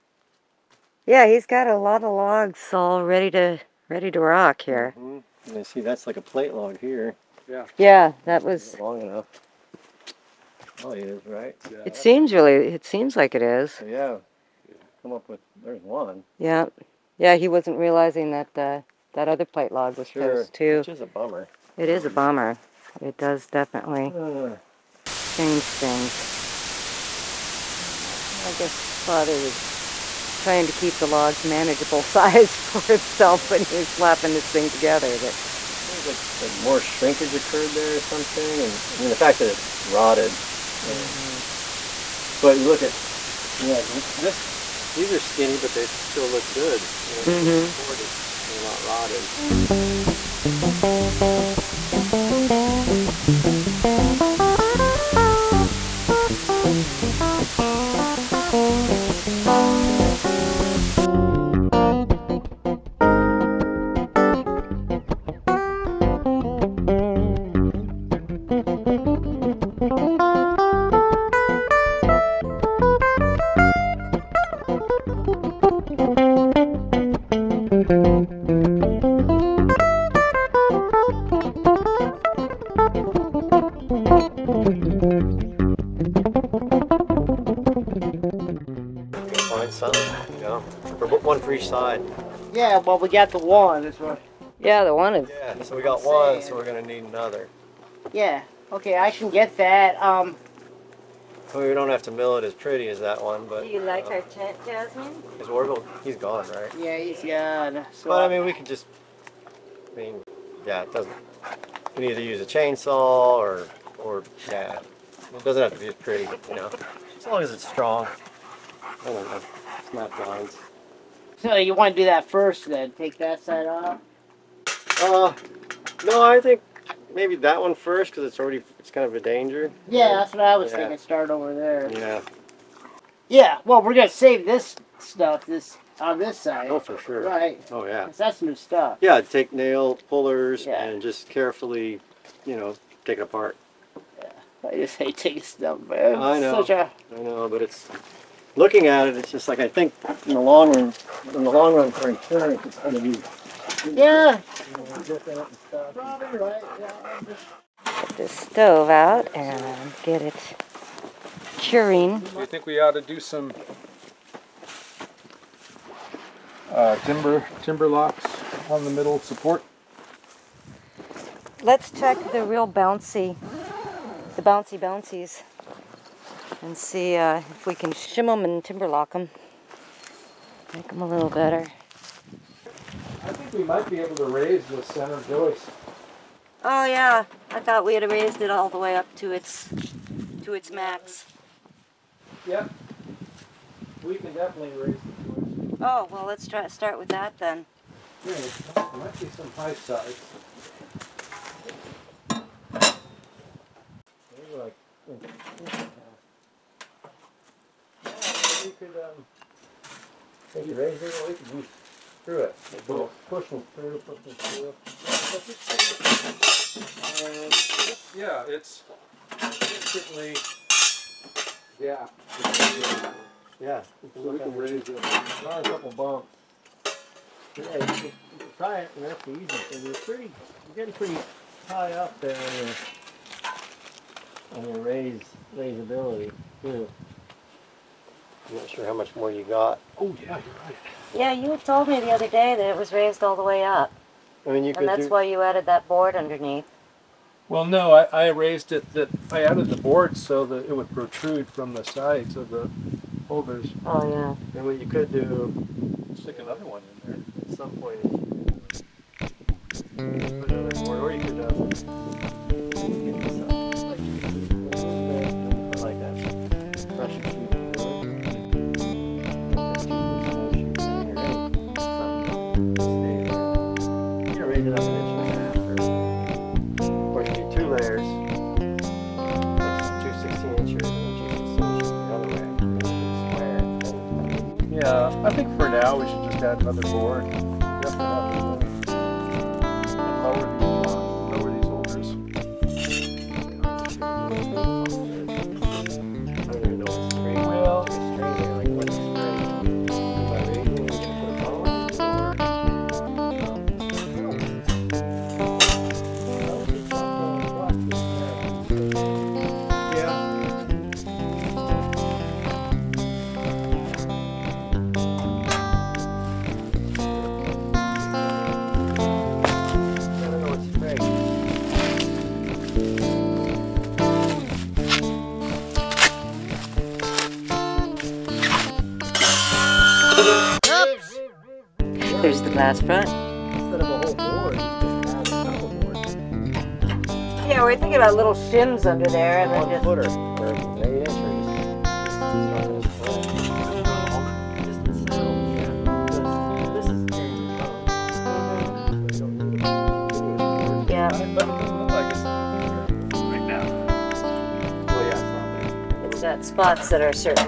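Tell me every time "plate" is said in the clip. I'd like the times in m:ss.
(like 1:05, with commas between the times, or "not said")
0:06, 0:19.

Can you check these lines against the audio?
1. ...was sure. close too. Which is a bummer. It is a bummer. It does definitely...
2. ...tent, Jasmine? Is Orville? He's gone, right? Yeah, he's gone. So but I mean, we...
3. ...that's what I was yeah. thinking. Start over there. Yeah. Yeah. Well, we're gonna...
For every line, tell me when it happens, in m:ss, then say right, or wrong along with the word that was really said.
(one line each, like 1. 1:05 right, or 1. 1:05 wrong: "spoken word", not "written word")
1. 0:19 right
2. 1:44 right
3. 2:10 right.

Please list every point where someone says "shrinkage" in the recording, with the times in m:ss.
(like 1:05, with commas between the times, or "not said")
0:36.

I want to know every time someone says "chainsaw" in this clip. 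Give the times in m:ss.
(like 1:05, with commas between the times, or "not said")
1:52.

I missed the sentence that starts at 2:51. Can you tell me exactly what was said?
Let's check the real bouncy, the bouncy bouncies and see uh, if we can shim them and timberlock them.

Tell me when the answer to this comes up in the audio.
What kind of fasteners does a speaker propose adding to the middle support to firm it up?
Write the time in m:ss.
2:47.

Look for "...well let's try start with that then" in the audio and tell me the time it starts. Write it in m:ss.
3:16.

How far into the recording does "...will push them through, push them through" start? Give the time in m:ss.
3:32.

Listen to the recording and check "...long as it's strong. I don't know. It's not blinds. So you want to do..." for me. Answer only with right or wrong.
right.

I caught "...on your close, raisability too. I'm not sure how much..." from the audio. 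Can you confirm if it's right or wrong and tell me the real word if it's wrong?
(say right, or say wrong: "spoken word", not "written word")
wrong: "raise", not "close".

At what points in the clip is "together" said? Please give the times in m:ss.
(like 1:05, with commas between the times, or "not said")
0:34.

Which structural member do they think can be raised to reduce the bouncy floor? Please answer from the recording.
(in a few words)
center joist.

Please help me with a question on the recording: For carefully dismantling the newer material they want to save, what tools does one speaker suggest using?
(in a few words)
nail pullers.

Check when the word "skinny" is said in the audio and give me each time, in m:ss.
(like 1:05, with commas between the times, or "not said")
0:45.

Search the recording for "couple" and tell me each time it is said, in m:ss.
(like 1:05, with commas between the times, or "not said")
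3:45.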